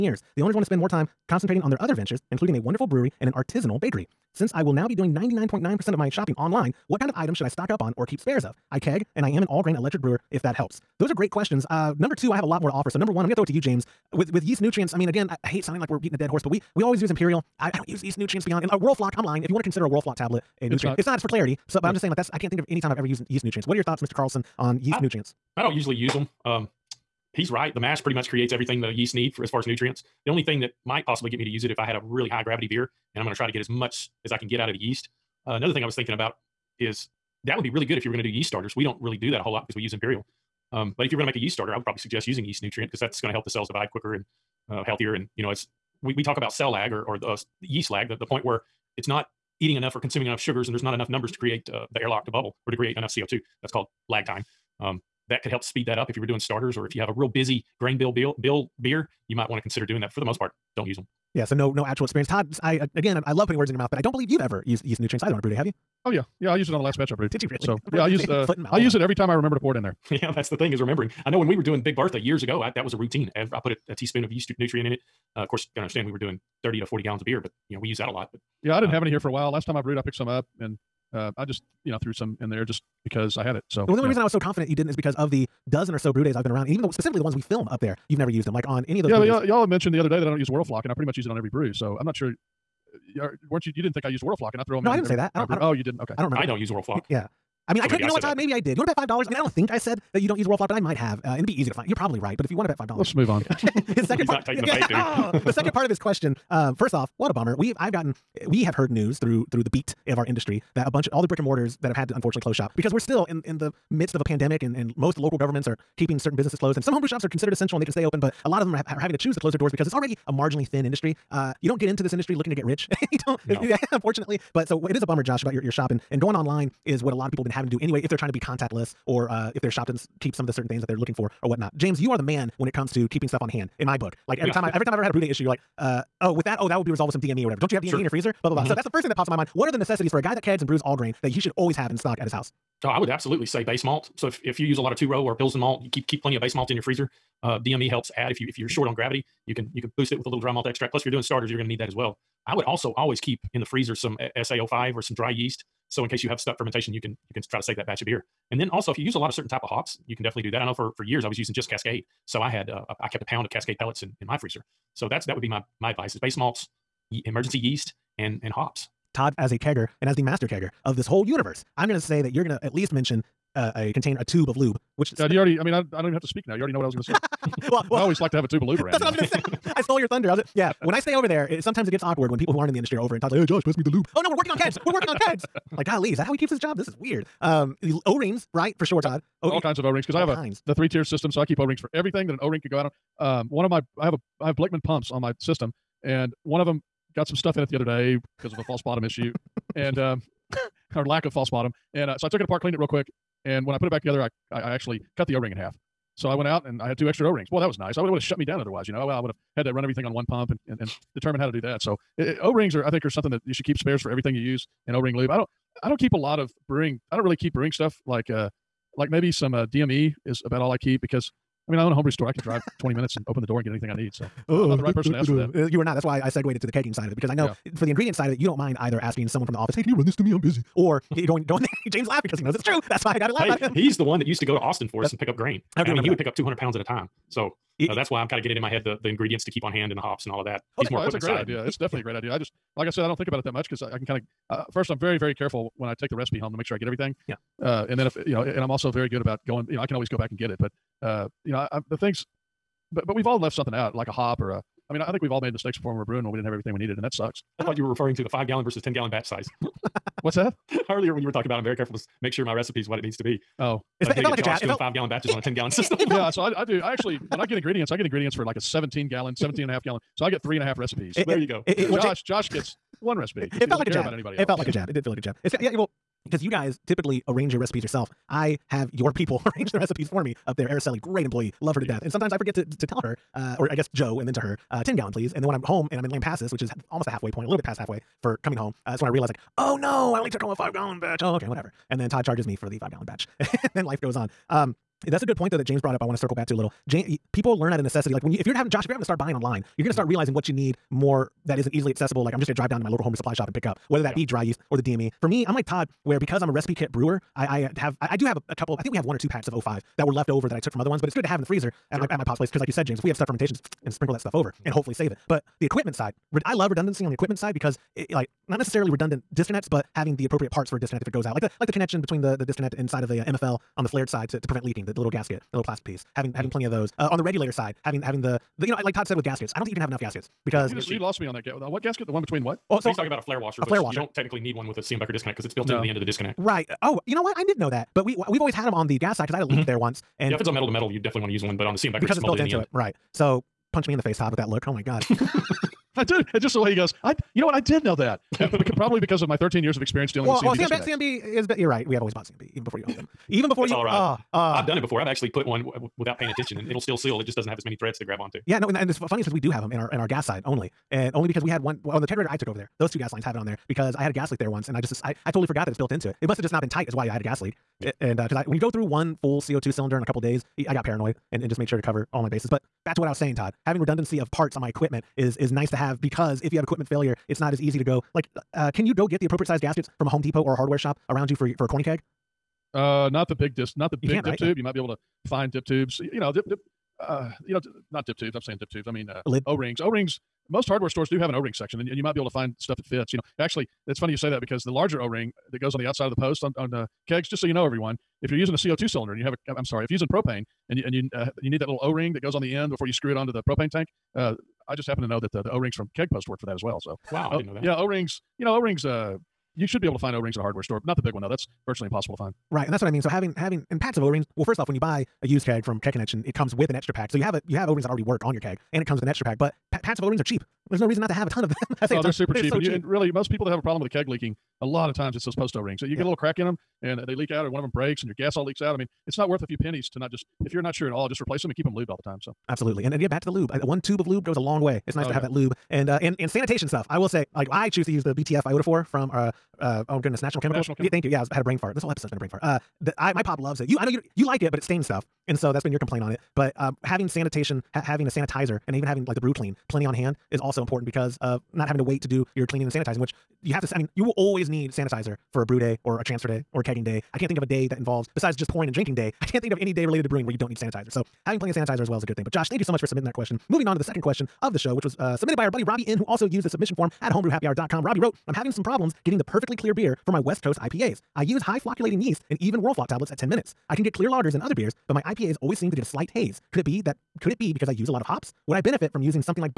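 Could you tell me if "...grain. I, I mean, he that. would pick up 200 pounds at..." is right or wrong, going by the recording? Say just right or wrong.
right.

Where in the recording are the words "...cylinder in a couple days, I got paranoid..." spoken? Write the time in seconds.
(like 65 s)
369 s.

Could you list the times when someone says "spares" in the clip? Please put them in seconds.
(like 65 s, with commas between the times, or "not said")
8 s, 213 s.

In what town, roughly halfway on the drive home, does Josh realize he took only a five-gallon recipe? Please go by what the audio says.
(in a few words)
Lampasas.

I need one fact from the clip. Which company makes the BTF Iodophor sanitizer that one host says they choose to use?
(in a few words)
National Chemicals.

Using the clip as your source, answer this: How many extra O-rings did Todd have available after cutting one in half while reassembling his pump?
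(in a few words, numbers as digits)
2.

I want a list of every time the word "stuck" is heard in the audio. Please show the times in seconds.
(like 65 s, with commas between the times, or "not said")
156 s, 313 s.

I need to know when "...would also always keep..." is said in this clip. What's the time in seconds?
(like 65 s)
152 s.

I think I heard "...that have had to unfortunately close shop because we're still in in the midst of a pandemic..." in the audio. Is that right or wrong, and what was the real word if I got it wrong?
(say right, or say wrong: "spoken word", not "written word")
right.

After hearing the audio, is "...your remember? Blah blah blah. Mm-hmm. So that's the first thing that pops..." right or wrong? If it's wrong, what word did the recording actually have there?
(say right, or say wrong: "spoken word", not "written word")
wrong: "freezer", not "remember".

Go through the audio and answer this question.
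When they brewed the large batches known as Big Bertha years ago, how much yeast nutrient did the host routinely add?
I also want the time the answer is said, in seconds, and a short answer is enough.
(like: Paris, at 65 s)
a teaspoon, at 73 s.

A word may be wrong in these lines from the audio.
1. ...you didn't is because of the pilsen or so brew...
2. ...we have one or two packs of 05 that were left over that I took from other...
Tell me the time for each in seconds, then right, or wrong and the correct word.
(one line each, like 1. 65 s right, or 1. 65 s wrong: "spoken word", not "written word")
1. 84 s wrong: "dozen", not "pilsen"
2. 308 s right.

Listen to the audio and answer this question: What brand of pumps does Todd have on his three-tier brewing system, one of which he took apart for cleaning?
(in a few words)
Blichmann.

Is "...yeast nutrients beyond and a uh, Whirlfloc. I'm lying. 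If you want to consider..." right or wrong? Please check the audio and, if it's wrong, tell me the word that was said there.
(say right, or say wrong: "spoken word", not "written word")
right.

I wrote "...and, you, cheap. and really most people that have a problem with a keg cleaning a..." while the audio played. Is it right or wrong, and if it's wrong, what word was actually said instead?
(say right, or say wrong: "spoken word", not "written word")
wrong: "leaking", not "cleaning".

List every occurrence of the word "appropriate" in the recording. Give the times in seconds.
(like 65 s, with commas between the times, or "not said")
320 s, 379 s.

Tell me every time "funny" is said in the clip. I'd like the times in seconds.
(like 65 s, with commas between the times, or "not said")
358 s, 393 s.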